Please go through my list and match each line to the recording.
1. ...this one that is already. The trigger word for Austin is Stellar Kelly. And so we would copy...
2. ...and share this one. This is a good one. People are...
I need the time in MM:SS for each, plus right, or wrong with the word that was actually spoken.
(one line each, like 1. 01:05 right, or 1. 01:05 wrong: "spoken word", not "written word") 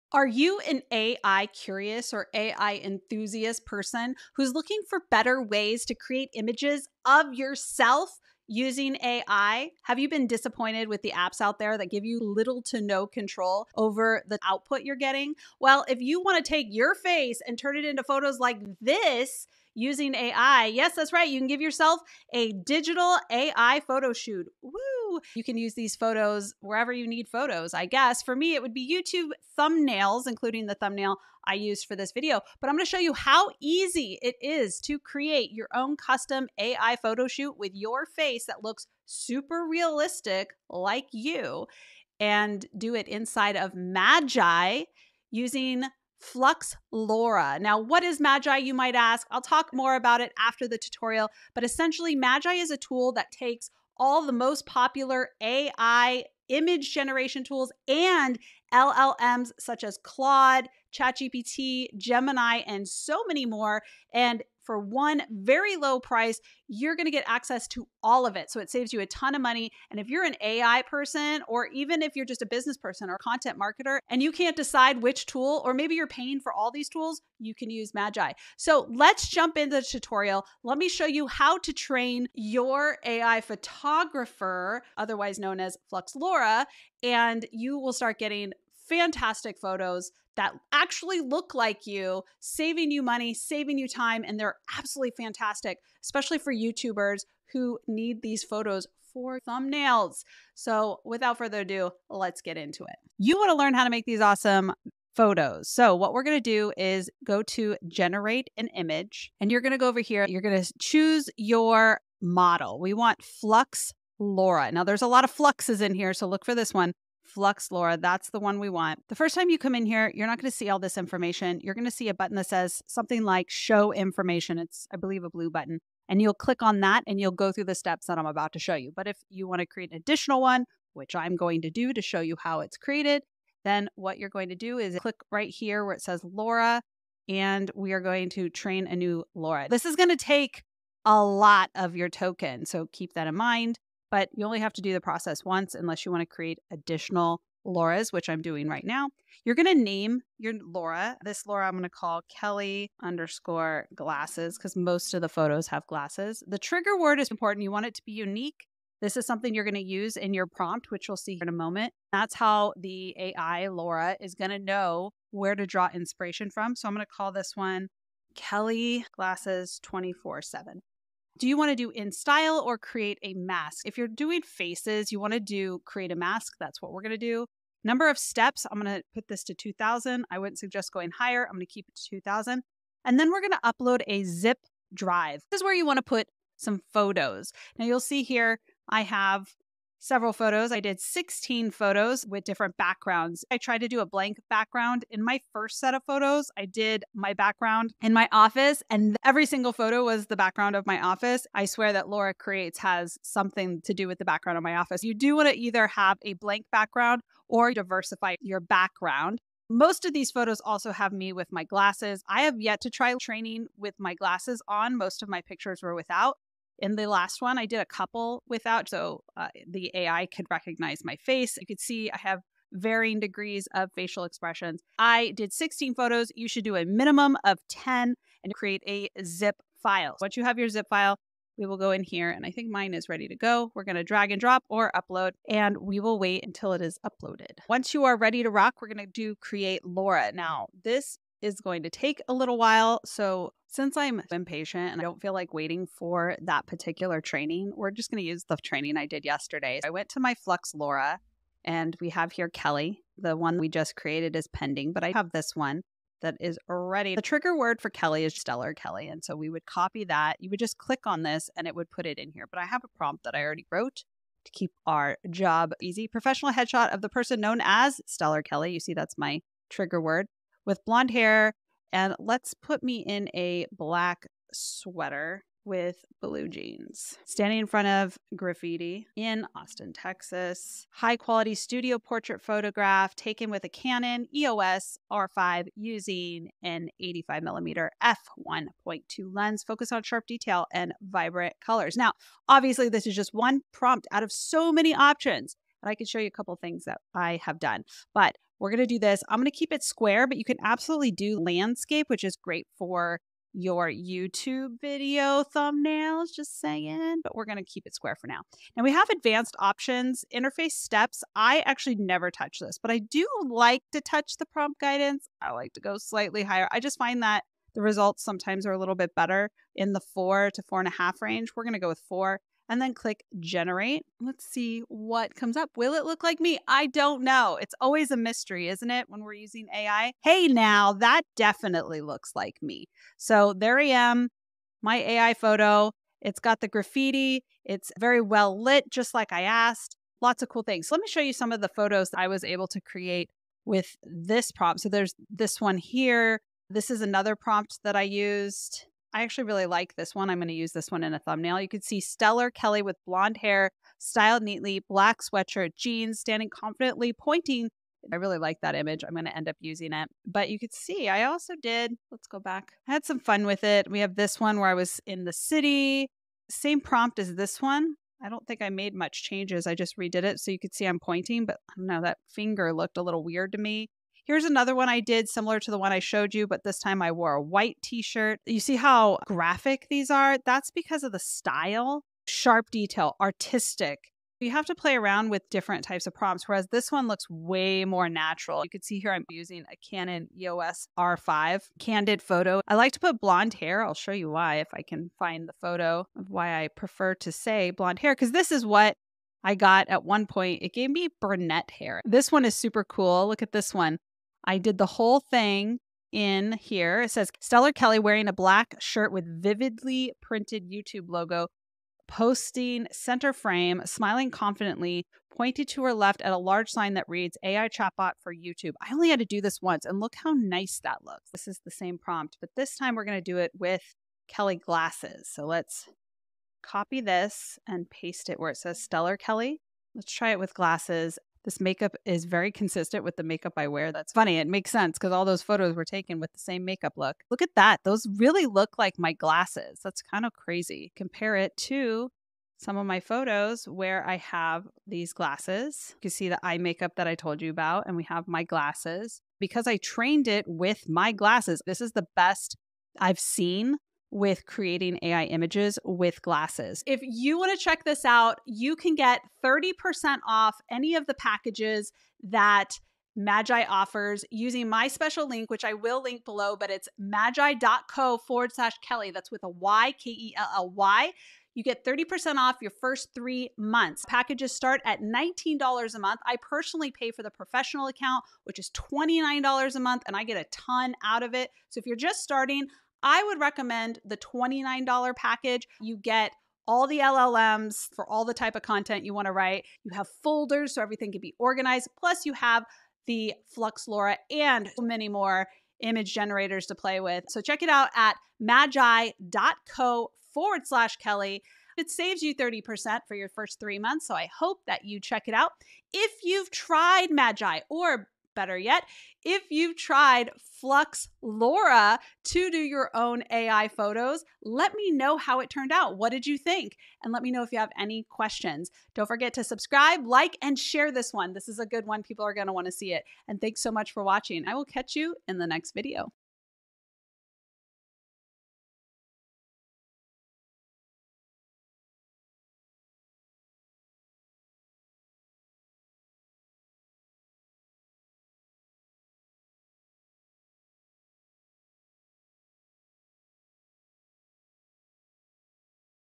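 1. 04:15 wrong: "Kelly", not "Austin"
2. 08:40 right.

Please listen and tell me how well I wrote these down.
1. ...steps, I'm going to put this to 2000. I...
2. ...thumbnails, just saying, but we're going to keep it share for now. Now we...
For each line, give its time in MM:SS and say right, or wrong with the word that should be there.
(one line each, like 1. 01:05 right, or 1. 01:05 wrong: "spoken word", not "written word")
1. 02:58 right
2. 05:05 wrong: "square", not "share".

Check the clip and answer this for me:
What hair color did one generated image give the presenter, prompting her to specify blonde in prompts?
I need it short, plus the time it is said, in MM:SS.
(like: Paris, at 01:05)
Brunette, at 06:41.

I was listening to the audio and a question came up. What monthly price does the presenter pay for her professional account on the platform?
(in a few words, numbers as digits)
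$29.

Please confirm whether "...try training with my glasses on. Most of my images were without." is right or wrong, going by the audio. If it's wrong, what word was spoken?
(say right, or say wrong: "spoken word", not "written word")
wrong: "pictures", not "images".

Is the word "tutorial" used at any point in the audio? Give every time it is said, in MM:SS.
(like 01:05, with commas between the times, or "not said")
00:50, 01:19.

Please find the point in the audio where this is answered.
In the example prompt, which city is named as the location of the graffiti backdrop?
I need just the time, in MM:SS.
04:39.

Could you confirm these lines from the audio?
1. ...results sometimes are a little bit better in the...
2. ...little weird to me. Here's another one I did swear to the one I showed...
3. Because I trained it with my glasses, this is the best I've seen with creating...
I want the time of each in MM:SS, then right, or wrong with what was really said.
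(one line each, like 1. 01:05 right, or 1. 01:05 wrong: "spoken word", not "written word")
1. 05:17 right
2. 06:13 wrong: "similar", not "swear"
3. 07:29 right.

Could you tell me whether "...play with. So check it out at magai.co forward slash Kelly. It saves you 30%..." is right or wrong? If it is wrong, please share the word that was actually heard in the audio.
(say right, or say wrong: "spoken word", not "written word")
right.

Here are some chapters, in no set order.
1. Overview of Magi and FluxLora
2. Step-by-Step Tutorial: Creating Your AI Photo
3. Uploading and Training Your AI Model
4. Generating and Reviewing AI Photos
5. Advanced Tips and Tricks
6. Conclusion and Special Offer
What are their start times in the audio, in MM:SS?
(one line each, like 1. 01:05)
1. 00:47
2. 01:43
3. 03:01
4. 04:00
5. 04:59
6. 07:44.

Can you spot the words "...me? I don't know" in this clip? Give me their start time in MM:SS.
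05:26.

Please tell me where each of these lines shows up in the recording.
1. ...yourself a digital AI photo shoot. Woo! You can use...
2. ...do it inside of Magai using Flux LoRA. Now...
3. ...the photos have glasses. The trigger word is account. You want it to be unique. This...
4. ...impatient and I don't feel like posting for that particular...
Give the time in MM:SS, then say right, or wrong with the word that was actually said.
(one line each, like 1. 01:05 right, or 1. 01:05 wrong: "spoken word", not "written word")
1. 00:21 right
2. 00:42 right
3. 02:35 wrong: "important", not "account"
4. 04:04 wrong: "waiting", not "posting".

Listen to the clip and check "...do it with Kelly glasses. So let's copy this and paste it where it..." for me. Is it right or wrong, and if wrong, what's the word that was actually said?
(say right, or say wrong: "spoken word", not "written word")
right.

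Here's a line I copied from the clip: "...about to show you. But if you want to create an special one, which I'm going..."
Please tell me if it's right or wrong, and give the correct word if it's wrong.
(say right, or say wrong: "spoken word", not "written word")
wrong: "additional", not "special".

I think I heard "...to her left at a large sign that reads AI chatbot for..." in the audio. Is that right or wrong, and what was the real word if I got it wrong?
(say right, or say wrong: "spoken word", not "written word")
right.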